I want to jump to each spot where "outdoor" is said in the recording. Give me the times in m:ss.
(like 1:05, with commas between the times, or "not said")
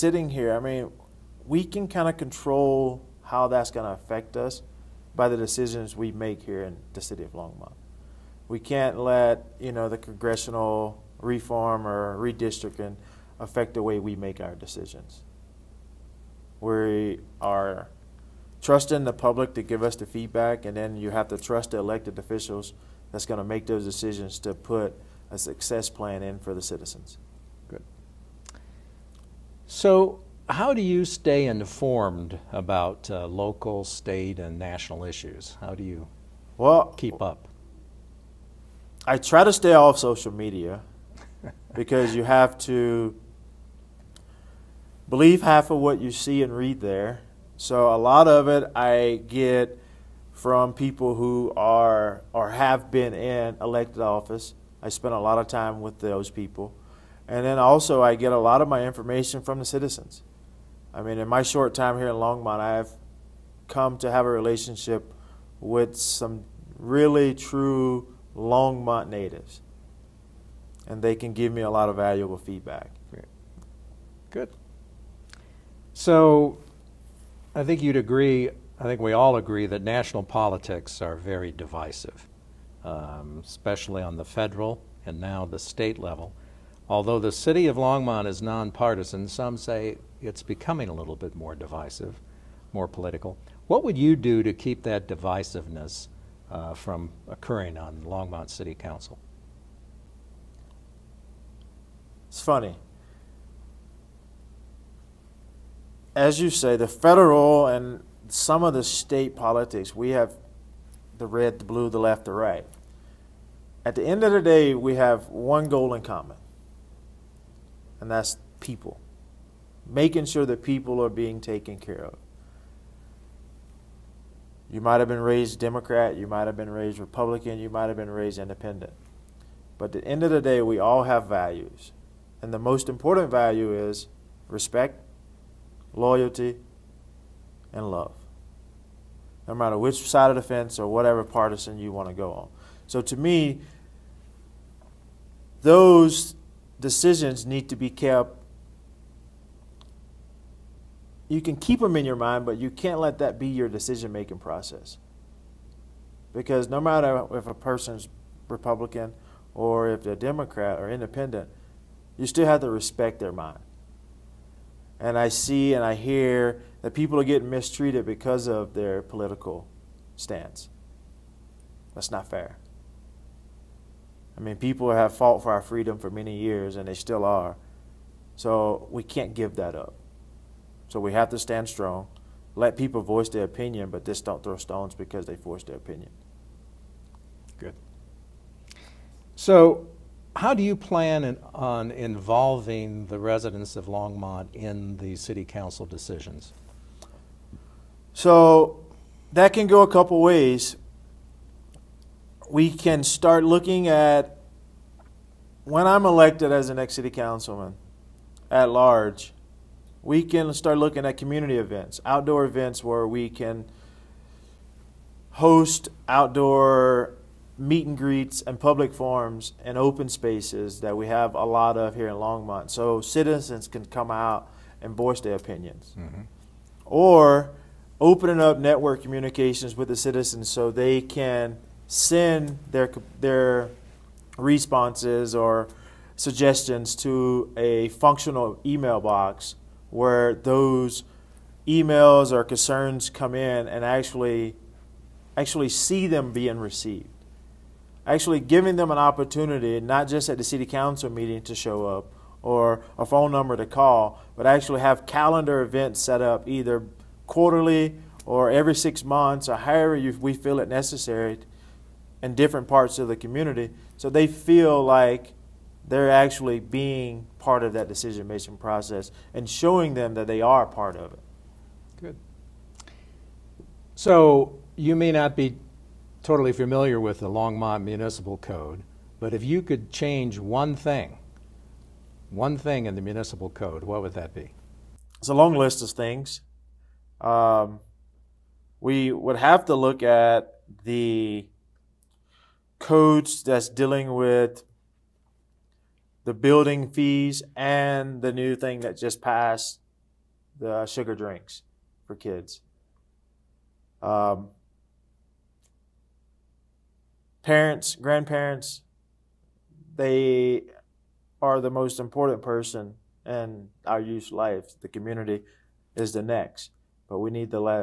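3:32, 3:36.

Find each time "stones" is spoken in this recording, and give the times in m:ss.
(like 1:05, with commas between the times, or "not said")
3:04.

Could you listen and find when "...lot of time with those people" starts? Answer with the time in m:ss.
0:55.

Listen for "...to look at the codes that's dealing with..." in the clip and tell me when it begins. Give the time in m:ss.
4:49.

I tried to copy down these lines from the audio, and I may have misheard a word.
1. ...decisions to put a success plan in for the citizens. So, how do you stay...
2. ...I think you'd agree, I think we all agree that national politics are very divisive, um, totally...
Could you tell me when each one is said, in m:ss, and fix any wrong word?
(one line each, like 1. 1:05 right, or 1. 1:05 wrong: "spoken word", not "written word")
1. 0:23 right
2. 1:17 wrong: "especially", not "totally".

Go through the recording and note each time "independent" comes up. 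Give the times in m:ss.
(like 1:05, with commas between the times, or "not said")
2:08, 2:40.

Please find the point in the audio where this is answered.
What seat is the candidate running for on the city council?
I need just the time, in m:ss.
3:26.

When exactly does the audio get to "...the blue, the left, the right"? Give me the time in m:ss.
1:51.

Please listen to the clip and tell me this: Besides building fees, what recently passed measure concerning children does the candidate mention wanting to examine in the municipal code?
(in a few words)
Sugar drinks for kids.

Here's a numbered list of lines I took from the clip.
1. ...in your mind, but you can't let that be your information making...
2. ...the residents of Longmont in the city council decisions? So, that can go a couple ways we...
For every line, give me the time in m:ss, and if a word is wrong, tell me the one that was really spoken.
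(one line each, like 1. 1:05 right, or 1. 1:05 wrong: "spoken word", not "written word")
1. 2:31 wrong: "decision", not "information"
2. 3:13 right.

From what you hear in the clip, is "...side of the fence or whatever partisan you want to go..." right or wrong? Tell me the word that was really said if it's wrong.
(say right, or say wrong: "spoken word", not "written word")
right.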